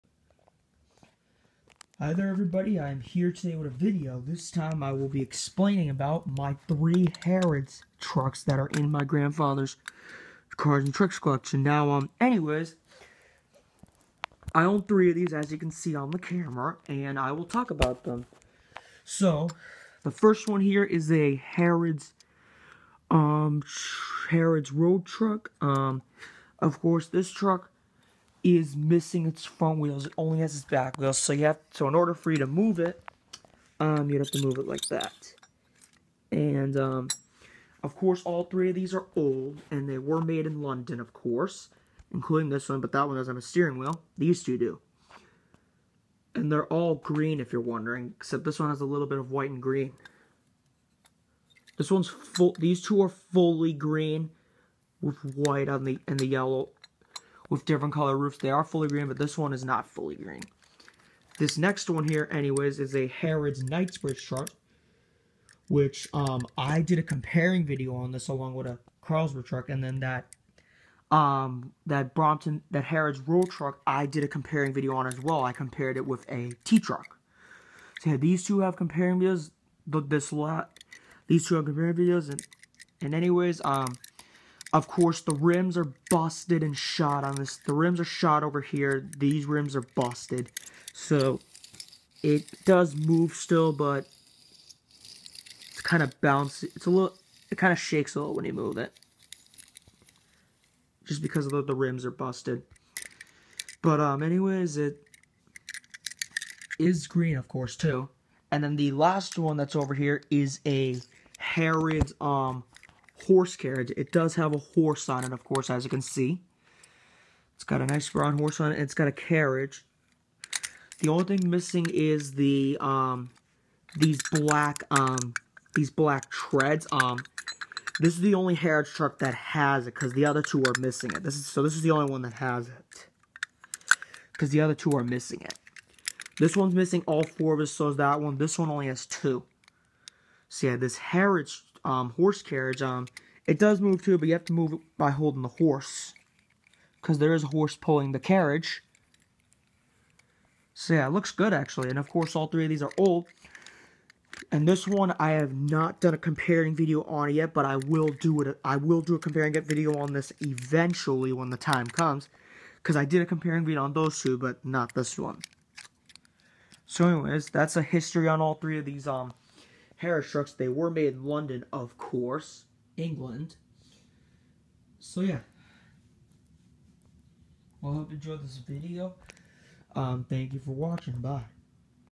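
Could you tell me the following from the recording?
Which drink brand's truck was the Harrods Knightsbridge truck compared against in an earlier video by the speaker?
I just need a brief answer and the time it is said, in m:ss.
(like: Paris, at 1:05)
Carlsberg, at 1:09.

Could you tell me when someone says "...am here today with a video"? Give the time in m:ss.
0:02.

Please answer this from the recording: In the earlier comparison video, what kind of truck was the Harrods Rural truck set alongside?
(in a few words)
T truck.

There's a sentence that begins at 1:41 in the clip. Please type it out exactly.
Just because the, the rims are busted.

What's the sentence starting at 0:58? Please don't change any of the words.
They are fully green, but this one is not fully green.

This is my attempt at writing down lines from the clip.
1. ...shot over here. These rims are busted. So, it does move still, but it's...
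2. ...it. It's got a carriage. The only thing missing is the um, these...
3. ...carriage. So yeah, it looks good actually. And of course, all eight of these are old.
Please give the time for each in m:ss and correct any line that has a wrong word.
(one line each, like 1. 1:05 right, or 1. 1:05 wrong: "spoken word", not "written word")
1. 1:28 right
2. 1:58 right
3. 2:28 wrong: "three", not "eight".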